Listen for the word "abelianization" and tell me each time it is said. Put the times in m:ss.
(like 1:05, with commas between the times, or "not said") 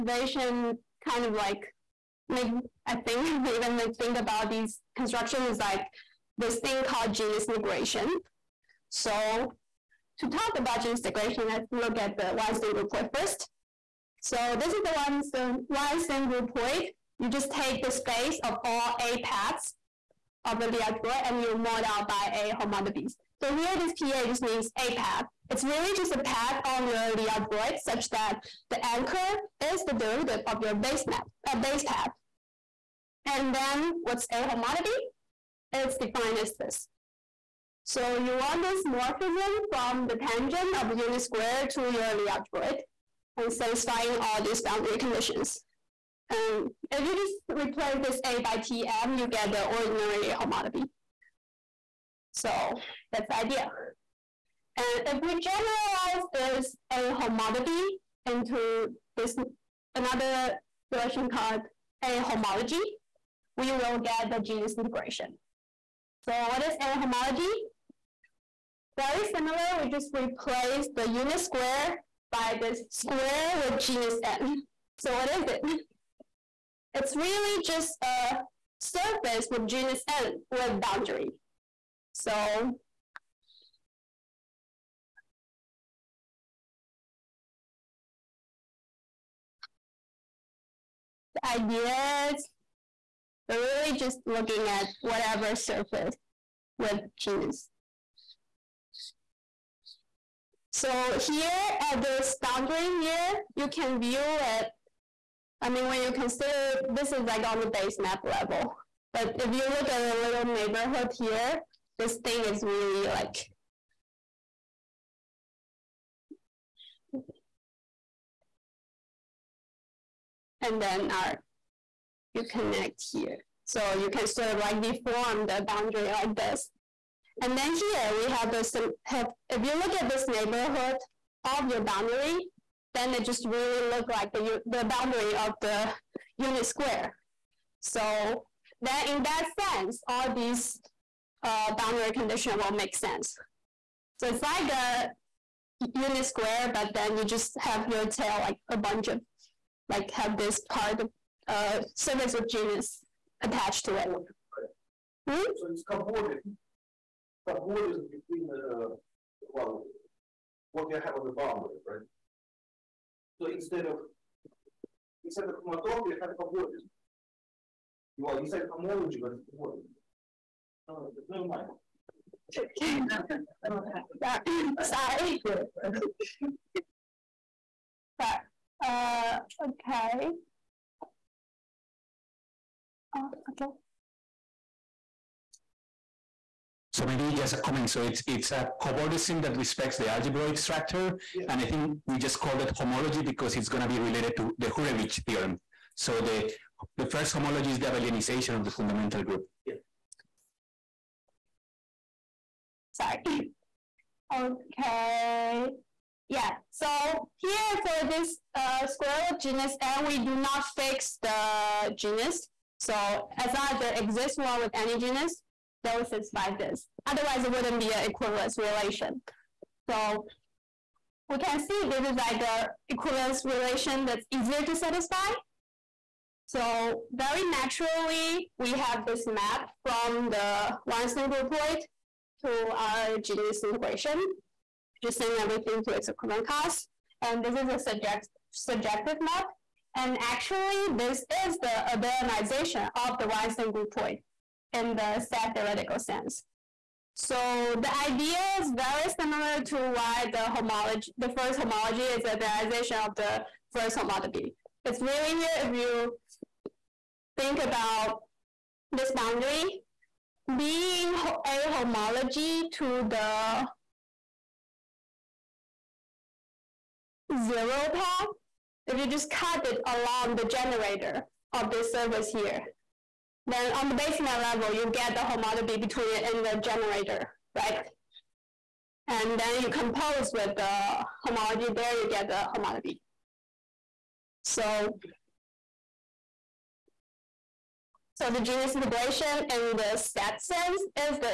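3:17, 4:01, 4:12.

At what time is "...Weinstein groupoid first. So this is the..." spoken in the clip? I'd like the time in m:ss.
0:12.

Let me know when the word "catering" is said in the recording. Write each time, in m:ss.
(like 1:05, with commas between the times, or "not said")
not said.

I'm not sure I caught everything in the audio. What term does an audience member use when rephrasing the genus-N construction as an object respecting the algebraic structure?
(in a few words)
cobordism.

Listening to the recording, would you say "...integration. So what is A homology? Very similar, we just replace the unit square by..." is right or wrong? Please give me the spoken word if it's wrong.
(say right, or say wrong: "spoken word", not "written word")
right.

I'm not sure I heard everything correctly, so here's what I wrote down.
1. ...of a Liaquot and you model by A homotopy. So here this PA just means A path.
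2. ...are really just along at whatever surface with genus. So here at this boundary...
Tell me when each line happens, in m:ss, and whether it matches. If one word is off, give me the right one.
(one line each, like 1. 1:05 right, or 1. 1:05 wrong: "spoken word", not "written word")
1. 0:20 right
2. 1:33 wrong: "looking", not "along".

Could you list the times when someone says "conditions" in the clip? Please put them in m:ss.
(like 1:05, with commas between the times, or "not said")
0:44, 2:22.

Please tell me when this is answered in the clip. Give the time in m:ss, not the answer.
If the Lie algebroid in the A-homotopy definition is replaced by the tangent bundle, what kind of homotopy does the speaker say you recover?
0:49.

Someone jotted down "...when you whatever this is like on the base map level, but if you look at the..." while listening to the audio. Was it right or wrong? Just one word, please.
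wrong.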